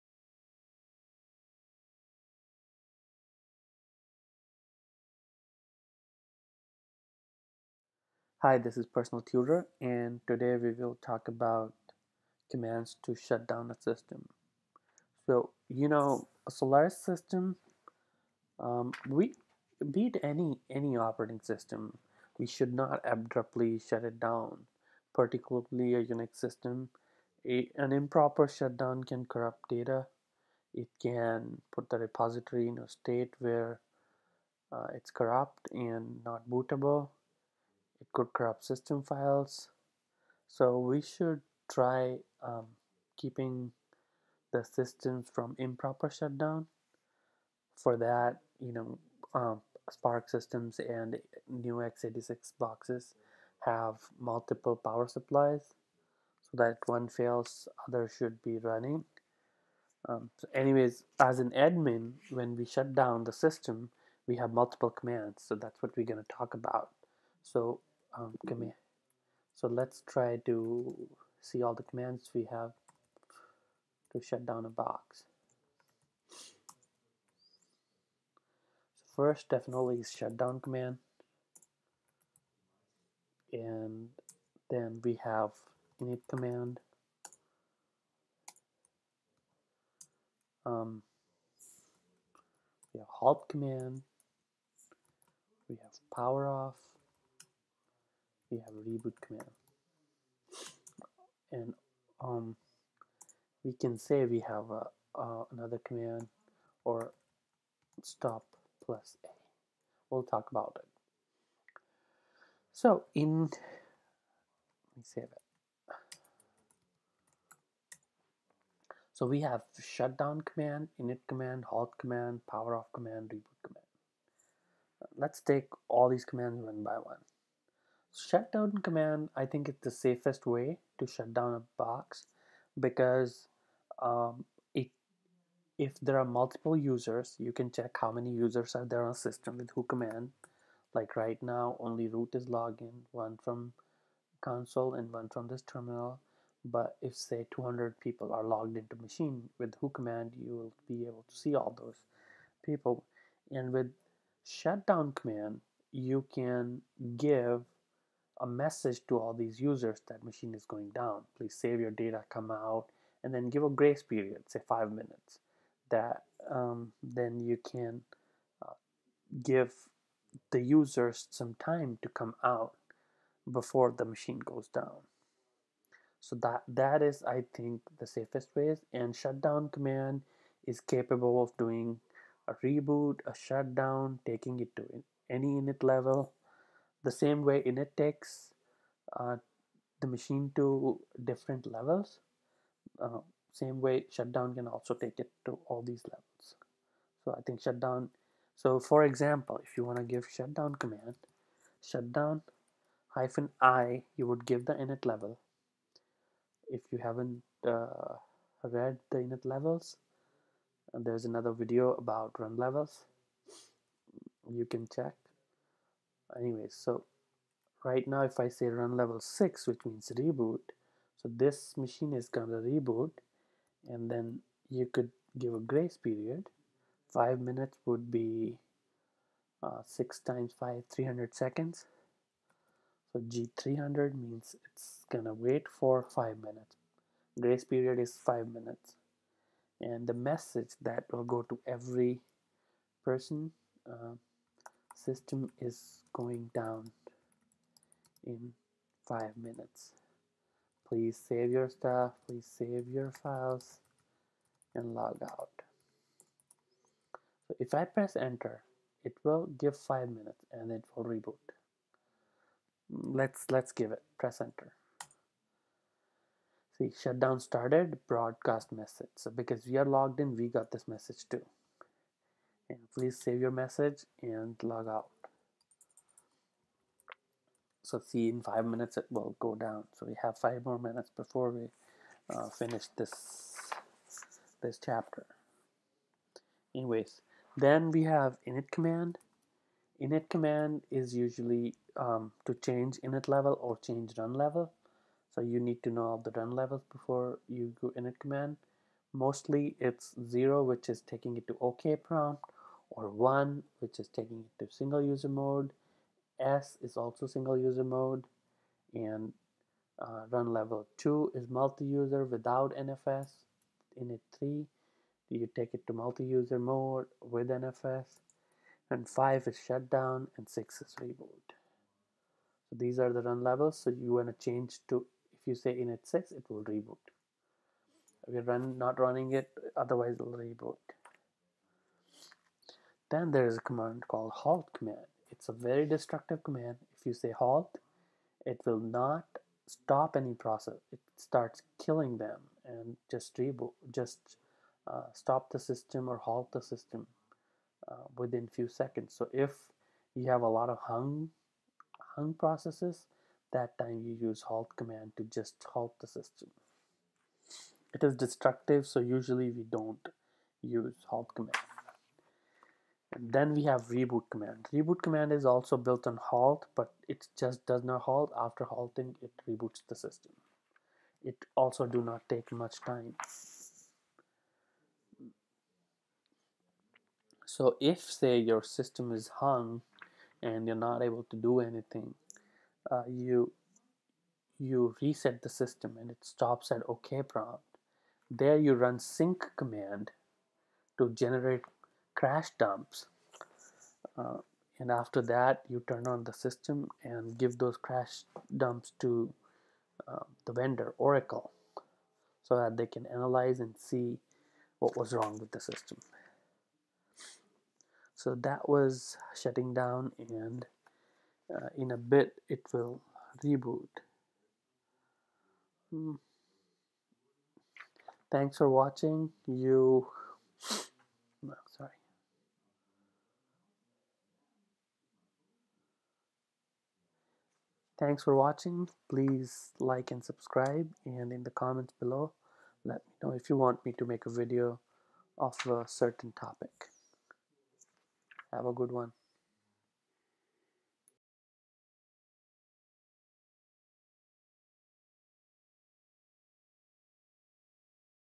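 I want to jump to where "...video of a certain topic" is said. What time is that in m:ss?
7:14.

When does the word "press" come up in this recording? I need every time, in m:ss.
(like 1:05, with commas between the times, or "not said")
4:17, 4:24.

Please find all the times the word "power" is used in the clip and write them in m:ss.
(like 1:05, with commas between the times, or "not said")
0:54, 1:36, 2:02.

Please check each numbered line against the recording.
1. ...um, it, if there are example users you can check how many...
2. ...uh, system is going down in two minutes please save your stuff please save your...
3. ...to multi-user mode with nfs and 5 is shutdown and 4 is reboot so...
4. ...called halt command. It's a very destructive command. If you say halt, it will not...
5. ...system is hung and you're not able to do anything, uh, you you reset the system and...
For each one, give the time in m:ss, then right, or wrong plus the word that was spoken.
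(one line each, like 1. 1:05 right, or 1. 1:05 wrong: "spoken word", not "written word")
1. 2:14 wrong: "multiple", not "example"
2. 4:03 wrong: "five", not "two"
3. 5:15 wrong: "6", not "4"
4. 5:34 right
5. 6:18 right.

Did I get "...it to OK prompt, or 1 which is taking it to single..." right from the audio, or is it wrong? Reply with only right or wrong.
right.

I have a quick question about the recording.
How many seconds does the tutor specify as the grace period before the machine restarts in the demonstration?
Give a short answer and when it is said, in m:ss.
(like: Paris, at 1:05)
300, at 3:50.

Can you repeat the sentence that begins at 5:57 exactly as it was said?
It is destructive, so usually we don't use halt command.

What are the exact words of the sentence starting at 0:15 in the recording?
So, you know, a Solaris system, um, we beat any any operating system.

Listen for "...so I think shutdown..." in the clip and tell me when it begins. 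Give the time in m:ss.
3:17.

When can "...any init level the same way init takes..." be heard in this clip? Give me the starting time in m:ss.
3:05.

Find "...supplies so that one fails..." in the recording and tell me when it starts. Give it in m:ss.
0:55.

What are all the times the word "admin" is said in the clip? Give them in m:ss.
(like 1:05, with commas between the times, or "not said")
1:01.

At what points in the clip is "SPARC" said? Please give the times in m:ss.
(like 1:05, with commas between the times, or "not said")
0:49.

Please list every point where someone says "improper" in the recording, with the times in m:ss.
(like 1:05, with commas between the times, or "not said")
0:27, 0:45.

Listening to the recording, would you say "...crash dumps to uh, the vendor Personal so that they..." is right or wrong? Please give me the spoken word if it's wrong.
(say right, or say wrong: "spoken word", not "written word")
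wrong: "Oracle", not "Personal".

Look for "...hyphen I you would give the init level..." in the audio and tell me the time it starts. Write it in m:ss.
3:23.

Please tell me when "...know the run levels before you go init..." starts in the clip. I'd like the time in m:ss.
4:55.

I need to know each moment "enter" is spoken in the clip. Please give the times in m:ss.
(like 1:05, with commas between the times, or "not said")
4:18, 4:24.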